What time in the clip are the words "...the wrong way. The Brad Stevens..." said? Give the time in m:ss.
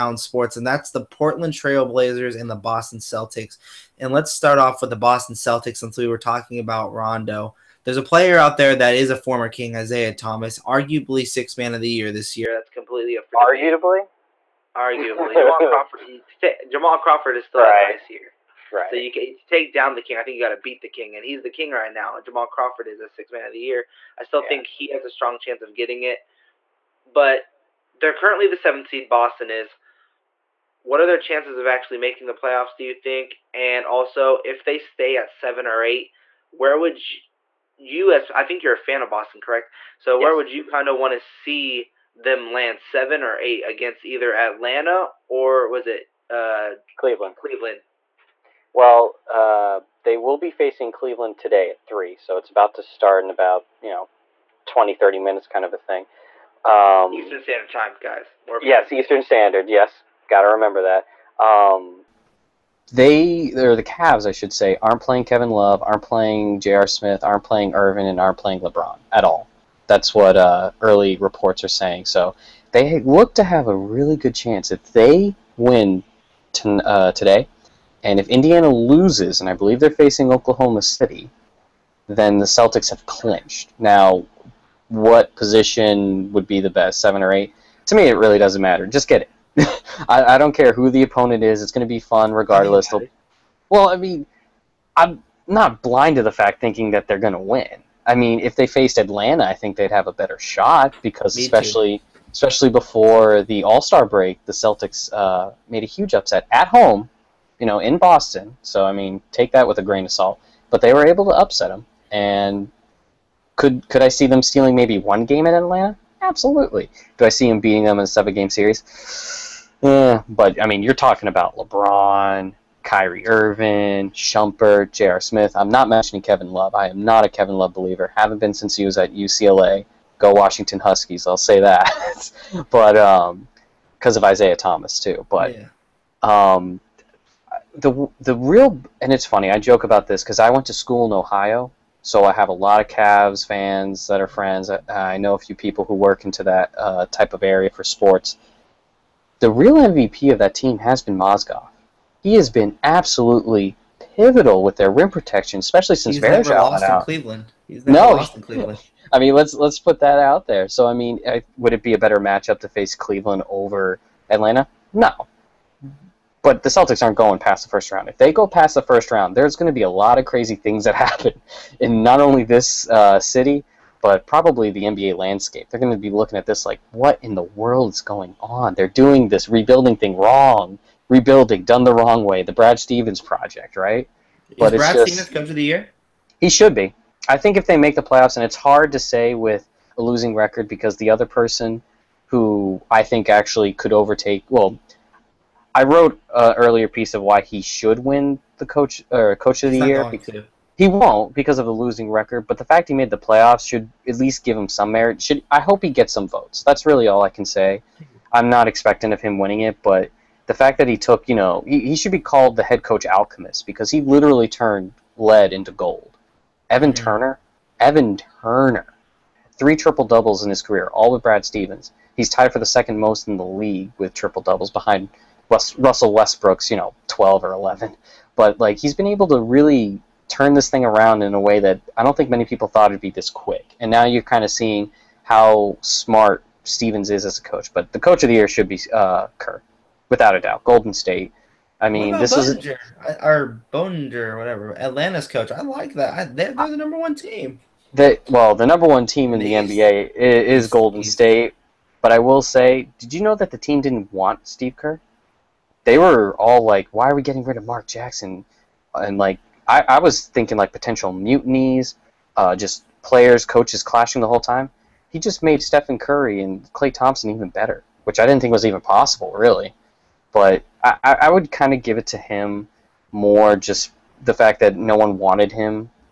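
3:01.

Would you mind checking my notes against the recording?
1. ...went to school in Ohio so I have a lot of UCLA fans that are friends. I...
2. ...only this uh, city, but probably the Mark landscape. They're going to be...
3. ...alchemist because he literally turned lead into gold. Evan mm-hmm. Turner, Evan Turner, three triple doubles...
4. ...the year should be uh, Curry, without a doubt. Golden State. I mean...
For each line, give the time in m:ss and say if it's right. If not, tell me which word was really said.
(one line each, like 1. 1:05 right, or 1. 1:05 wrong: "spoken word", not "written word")
1. 2:20 wrong: "Cavs", not "UCLA"
2. 2:52 wrong: "NBA", not "Mark"
3. 3:33 right
4. 3:58 wrong: "Kerr", not "Curry".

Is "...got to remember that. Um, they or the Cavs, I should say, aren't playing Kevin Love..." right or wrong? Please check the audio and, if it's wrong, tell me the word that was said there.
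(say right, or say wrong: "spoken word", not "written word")
right.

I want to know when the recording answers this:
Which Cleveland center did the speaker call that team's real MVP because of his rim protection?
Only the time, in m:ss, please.
2:31.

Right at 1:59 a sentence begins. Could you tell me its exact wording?
Yeah, but I mean, you're talking about LeBron, Kyrie Irving, Shumpert, J.R.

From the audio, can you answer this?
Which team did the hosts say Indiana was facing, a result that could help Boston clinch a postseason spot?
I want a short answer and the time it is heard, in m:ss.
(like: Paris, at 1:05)
Oklahoma City, at 1:20.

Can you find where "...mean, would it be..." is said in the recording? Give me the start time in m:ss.
2:40.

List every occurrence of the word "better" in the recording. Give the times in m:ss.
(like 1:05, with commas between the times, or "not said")
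1:40, 2:41, 4:27.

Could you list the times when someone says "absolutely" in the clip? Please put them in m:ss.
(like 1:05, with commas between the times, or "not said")
1:56, 2:32.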